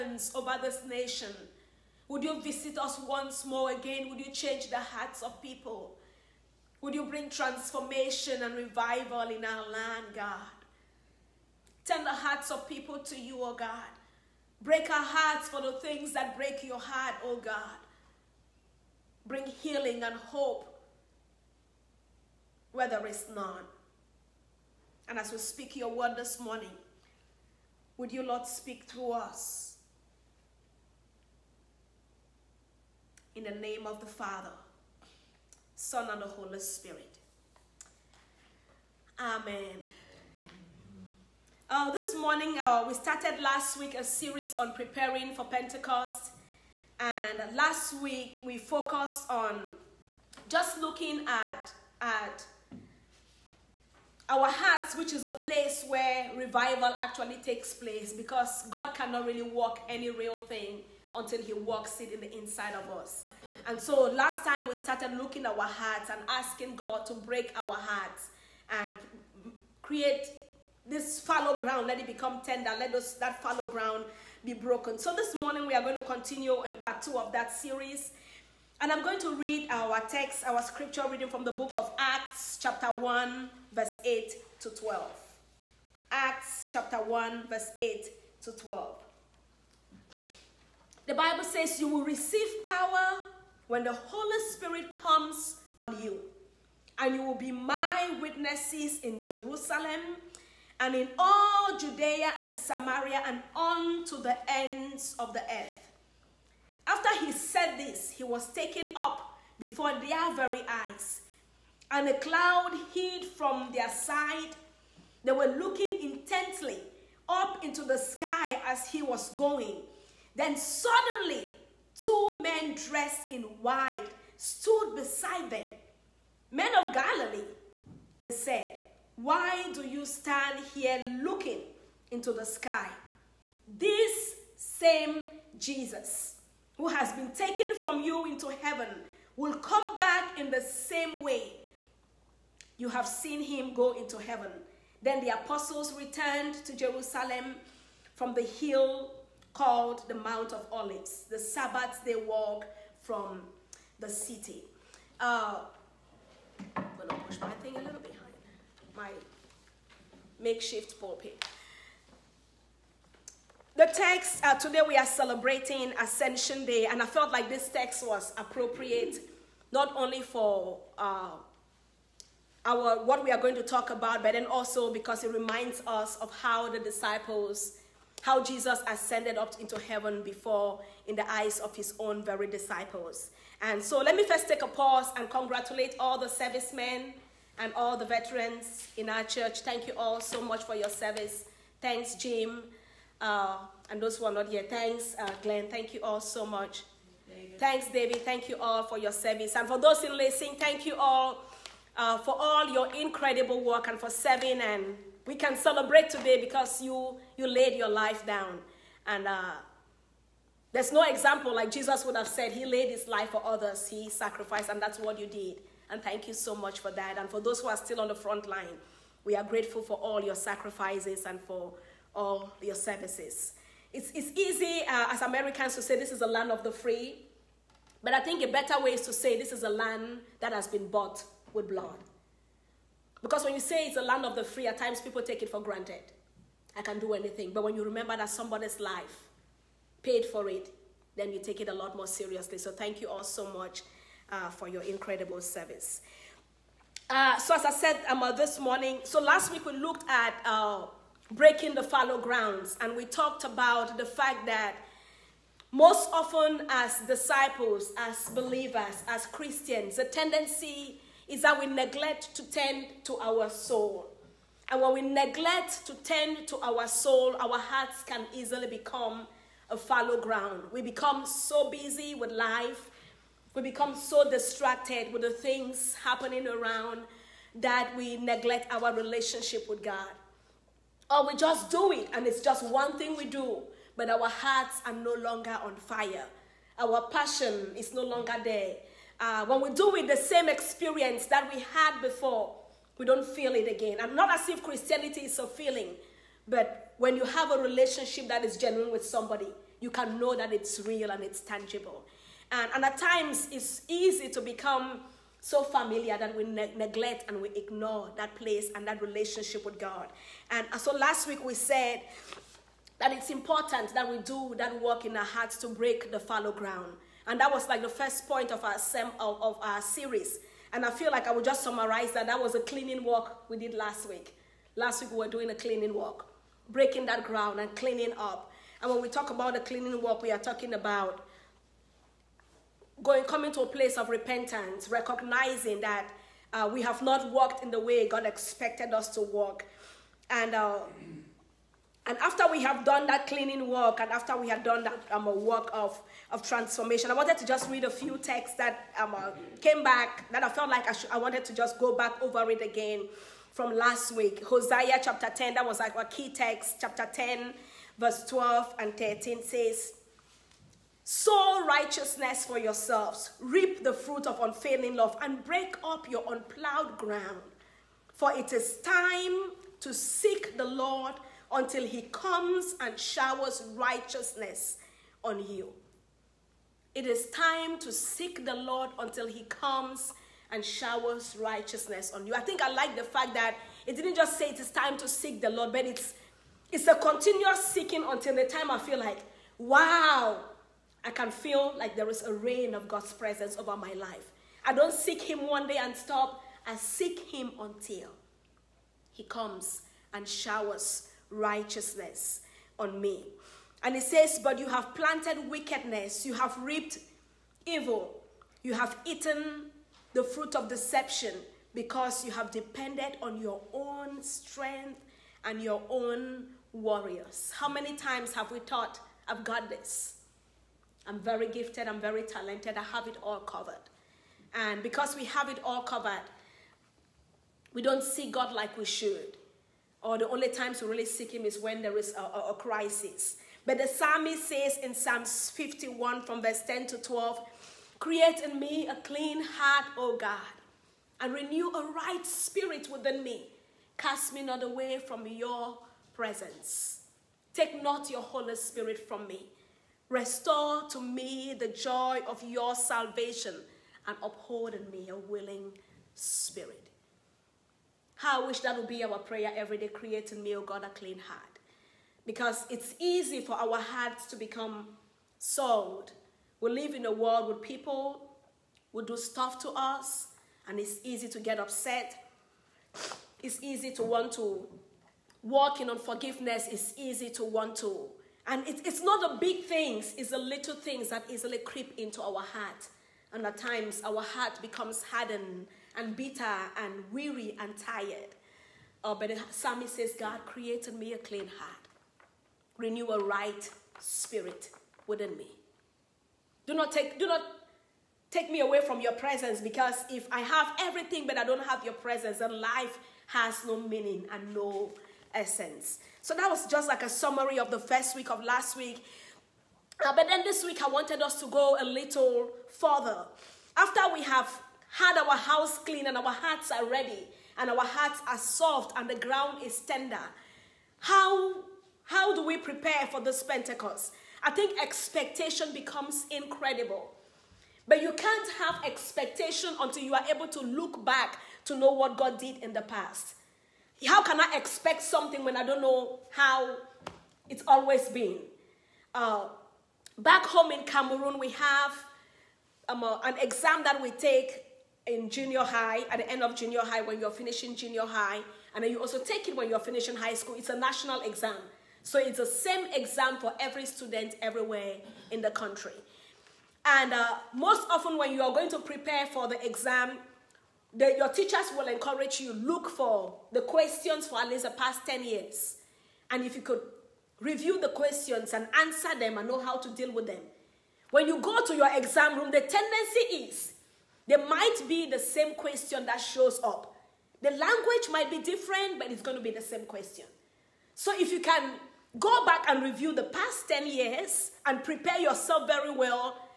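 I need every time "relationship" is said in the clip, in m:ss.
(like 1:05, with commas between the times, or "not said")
4:38, 4:57, 5:08.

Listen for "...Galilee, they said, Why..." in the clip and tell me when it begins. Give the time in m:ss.
2:06.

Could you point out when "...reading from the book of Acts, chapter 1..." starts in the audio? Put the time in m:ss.
1:21.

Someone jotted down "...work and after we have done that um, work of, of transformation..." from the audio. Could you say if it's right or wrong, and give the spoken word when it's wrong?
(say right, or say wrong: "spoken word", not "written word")
right.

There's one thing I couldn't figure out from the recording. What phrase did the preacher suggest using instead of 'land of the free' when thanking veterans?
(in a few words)
bought with blood.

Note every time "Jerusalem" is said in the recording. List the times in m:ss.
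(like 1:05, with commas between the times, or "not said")
1:39, 2:26.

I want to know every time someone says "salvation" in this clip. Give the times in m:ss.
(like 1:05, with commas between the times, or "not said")
7:32.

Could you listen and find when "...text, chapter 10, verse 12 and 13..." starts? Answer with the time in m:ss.
5:56.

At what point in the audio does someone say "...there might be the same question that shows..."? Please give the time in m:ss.
9:34.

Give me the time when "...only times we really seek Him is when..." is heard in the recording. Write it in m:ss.
7:10.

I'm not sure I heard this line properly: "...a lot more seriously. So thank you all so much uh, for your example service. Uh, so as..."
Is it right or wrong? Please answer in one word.
wrong.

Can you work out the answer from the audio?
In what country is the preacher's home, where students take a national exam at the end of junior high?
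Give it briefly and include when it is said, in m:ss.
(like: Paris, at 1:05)
Cameroon, at 9:00.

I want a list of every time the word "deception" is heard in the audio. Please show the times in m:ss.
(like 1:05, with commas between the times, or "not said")
6:50.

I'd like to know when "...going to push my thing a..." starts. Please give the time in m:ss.
2:36.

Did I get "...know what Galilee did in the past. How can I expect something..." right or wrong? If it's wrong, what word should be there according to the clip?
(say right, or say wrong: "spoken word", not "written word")
wrong: "God", not "Galilee".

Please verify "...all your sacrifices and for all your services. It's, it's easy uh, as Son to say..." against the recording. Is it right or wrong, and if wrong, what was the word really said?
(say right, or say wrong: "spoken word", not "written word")
wrong: "Americans", not "Son".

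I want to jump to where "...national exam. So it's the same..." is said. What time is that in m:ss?
9:10.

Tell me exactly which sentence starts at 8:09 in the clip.
Uh, but the psalmist says, God created me a clean heart, renew a right spirit within me.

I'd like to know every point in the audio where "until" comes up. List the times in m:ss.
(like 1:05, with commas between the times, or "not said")
1:01, 6:11, 6:18, 6:28, 6:37, 8:49.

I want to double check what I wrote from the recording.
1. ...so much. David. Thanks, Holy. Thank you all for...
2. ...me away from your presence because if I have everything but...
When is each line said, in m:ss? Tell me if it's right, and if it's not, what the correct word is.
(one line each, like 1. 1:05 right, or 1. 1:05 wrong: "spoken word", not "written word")
1. 3:16 wrong: "David", not "Holy"
2. 8:18 right.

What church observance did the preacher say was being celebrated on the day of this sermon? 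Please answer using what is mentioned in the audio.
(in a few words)
Ascension Day.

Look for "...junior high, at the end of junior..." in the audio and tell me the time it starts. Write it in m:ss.
9:05.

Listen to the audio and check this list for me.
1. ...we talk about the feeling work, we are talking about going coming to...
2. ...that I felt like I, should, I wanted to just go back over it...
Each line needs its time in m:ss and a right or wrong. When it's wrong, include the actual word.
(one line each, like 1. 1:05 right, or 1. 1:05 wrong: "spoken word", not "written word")
1. 5:28 wrong: "cleaning", not "feeling"
2. 5:50 right.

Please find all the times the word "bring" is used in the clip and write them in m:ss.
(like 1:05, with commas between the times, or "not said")
0:07, 0:19.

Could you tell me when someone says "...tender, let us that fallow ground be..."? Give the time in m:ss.
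1:12.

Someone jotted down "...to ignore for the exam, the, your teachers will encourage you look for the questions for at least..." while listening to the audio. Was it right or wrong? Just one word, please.
wrong.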